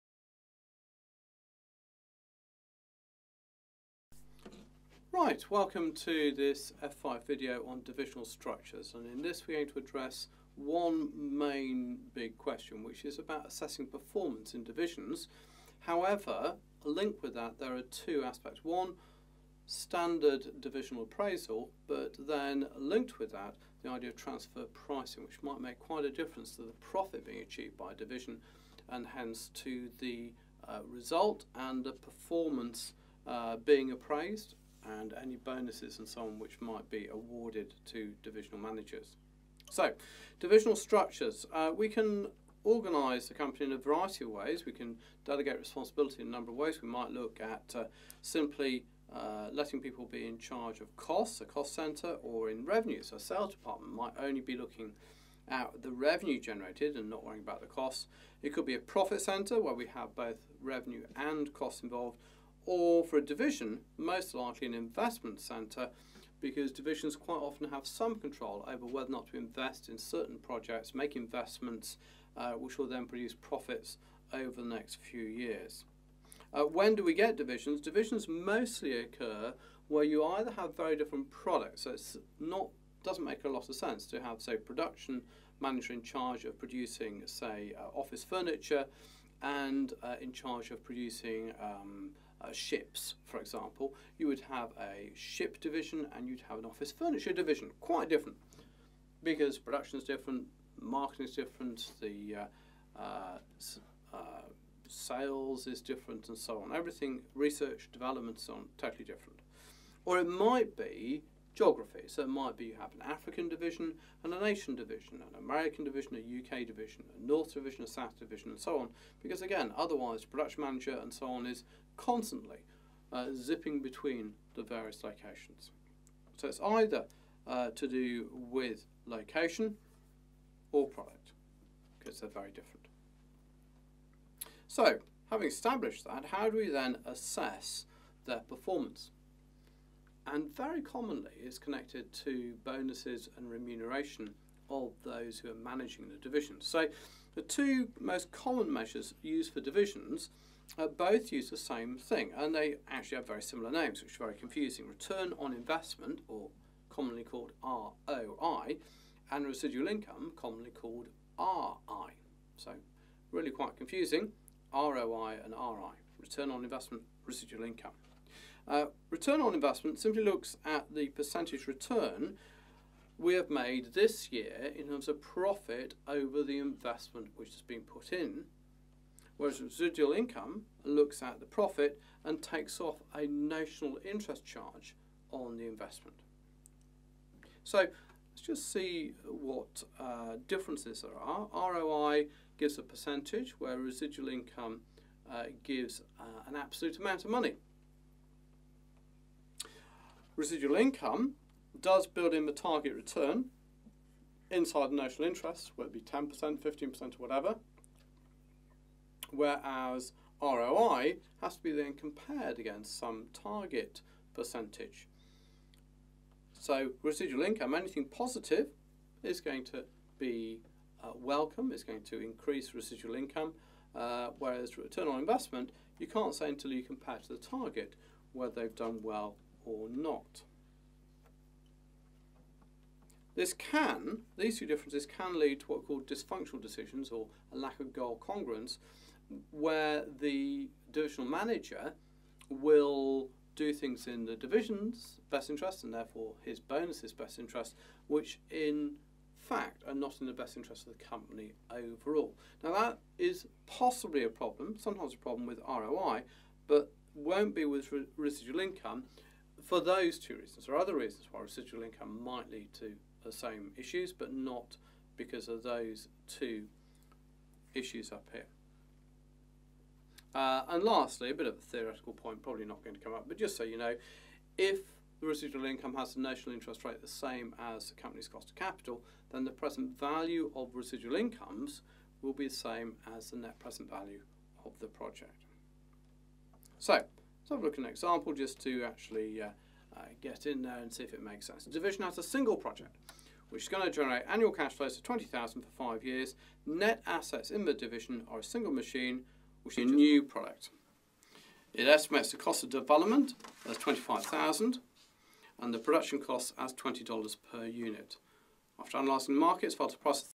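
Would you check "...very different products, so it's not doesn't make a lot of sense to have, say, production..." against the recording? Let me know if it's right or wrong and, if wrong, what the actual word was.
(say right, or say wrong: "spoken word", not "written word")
right.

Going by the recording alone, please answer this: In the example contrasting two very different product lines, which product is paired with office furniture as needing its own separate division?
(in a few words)
Ships.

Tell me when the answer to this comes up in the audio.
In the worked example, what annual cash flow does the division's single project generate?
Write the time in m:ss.
4:55.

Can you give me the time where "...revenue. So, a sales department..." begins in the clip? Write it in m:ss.
0:52.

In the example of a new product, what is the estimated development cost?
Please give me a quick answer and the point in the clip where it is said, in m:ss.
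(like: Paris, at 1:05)
25,000, at 5:03.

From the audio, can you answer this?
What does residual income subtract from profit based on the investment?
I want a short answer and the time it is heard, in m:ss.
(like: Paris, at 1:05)
A notional interest charge, at 3:03.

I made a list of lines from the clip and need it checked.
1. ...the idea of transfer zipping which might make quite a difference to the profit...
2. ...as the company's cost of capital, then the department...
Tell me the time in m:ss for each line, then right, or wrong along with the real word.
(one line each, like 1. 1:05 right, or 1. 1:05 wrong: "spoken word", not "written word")
1. 0:23 wrong: "pricing", not "zipping"
2. 4:37 wrong: "present", not "department".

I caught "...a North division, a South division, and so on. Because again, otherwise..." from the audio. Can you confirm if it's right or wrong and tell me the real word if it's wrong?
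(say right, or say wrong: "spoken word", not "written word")
right.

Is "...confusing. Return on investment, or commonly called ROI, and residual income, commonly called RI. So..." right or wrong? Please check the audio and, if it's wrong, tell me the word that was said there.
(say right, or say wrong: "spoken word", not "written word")
right.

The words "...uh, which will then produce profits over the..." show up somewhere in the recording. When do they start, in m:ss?
1:12.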